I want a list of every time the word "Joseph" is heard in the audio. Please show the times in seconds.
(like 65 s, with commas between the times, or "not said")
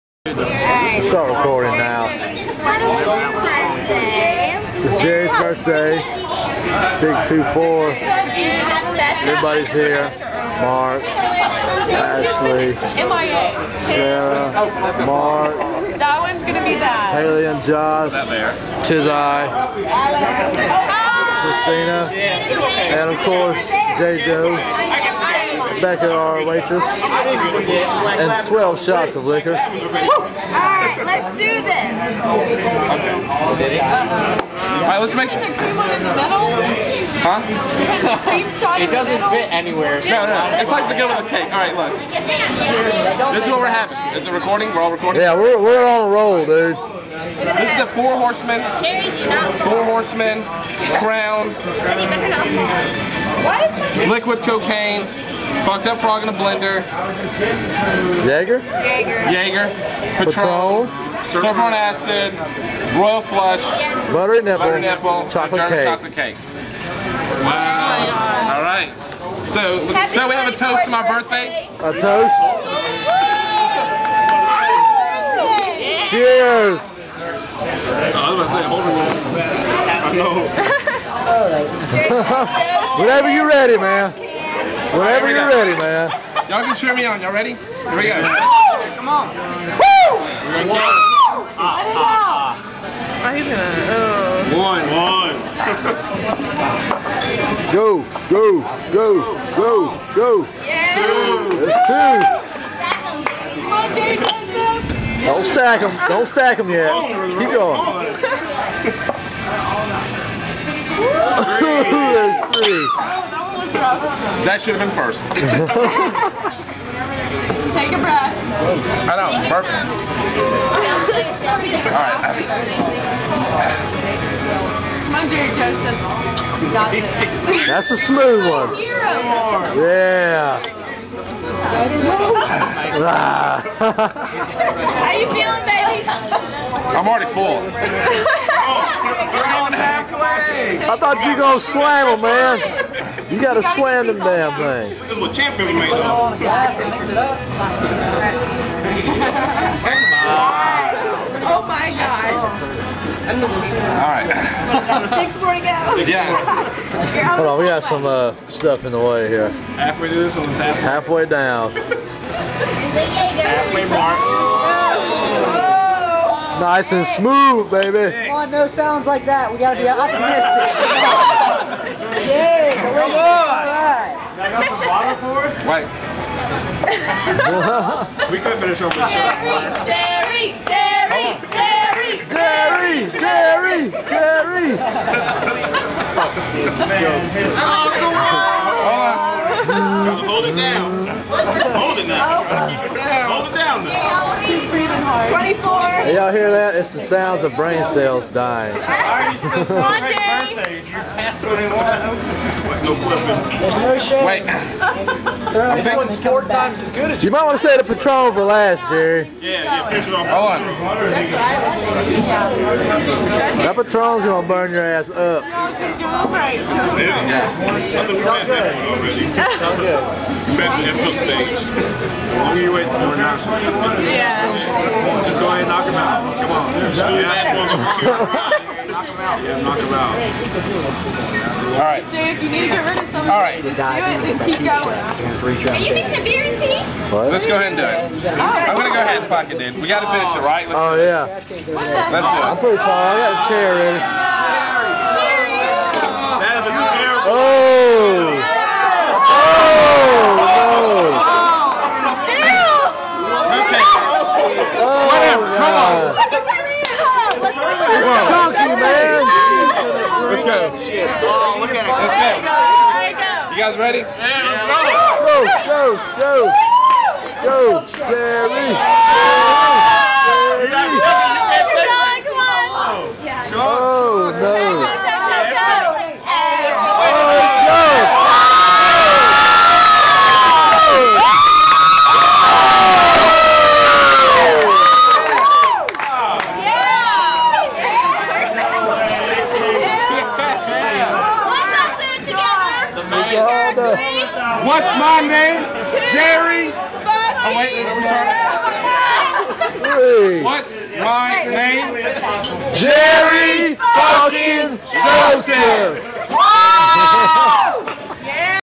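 125 s, 307 s.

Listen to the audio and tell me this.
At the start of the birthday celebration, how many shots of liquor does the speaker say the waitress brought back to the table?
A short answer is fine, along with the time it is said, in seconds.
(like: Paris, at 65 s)
12, at 28 s.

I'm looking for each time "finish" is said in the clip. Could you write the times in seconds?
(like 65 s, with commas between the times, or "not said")
178 s, 240 s.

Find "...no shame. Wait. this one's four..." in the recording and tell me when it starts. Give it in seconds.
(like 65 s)
203 s.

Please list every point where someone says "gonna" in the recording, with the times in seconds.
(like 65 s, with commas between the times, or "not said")
16 s, 90 s.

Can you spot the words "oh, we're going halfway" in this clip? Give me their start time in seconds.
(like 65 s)
137 s.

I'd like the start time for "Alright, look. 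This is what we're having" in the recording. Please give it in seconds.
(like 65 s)
41 s.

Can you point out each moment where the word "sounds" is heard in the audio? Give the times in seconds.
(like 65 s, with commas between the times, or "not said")
168 s, 197 s.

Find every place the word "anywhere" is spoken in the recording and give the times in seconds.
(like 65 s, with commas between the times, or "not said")
39 s.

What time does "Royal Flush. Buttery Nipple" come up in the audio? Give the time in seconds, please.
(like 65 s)
62 s.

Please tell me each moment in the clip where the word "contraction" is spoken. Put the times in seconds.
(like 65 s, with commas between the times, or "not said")
not said.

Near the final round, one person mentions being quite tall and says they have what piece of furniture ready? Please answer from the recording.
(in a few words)
Chair.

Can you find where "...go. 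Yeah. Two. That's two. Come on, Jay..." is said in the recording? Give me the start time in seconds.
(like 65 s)
100 s.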